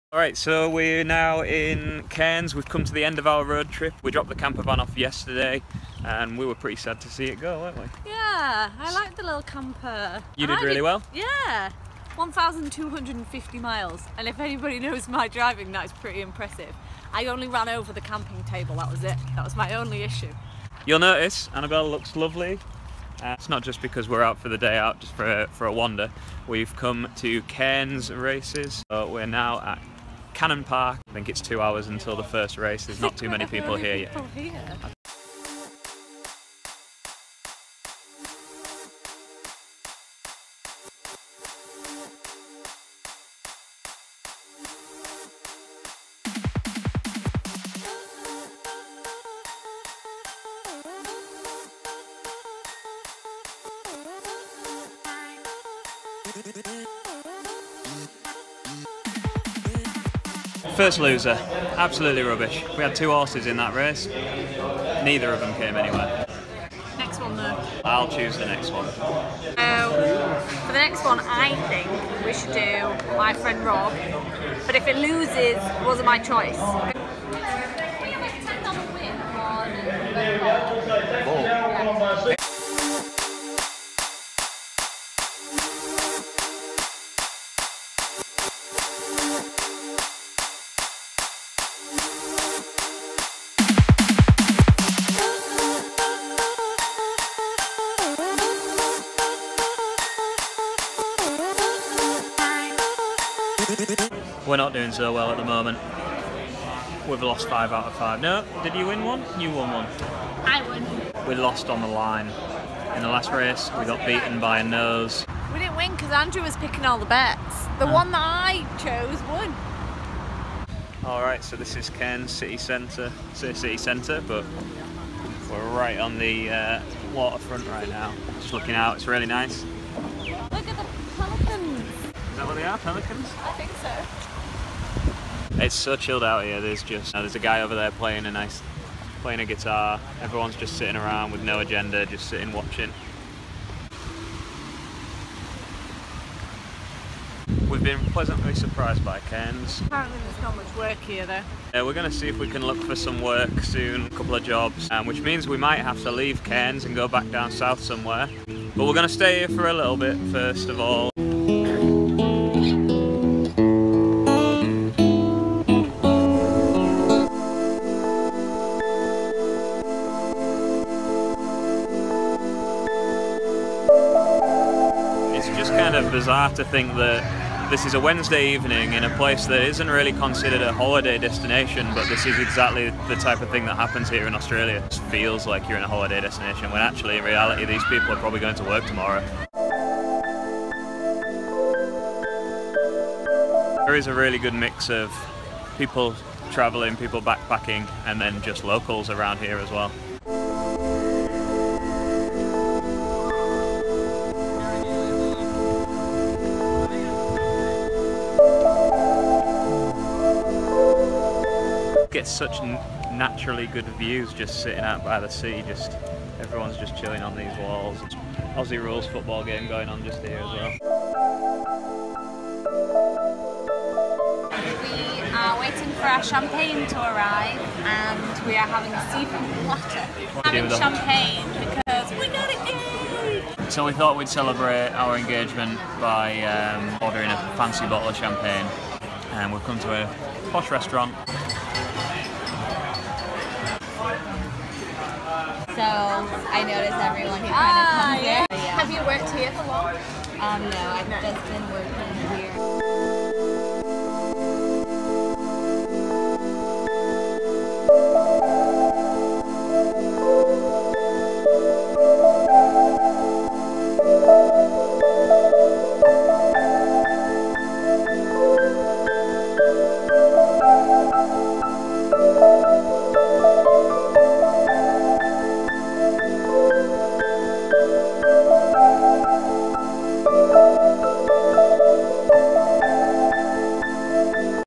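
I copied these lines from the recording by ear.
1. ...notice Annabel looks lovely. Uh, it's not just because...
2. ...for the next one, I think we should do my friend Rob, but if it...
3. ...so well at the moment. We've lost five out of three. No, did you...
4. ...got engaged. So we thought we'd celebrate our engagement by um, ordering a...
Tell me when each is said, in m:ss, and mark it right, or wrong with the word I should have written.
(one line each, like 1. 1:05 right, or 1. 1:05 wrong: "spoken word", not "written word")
1. 0:20 right
2. 1:10 right
3. 1:44 wrong: "five", not "three"
4. 3:52 right.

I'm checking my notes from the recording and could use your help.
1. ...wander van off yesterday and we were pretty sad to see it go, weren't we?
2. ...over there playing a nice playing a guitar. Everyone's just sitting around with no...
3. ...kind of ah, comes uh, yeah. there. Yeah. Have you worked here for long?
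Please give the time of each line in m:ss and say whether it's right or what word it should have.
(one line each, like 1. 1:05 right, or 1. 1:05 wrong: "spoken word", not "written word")
1. 0:04 wrong: "camper", not "wander"
2. 2:17 right
3. 4:07 right.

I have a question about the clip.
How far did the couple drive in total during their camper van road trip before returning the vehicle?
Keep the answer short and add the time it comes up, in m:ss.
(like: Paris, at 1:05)
1,250 miles, at 0:12.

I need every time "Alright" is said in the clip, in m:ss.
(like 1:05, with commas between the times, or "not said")
0:00, 2:01.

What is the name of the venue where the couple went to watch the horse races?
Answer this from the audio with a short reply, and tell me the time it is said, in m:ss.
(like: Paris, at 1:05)
Cannon Park, at 0:30.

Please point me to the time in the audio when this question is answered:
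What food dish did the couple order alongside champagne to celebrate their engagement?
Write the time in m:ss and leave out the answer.
3:49.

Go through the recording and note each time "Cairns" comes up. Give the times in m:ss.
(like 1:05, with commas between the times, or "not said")
0:02, 0:27, 2:01, 2:29, 2:36.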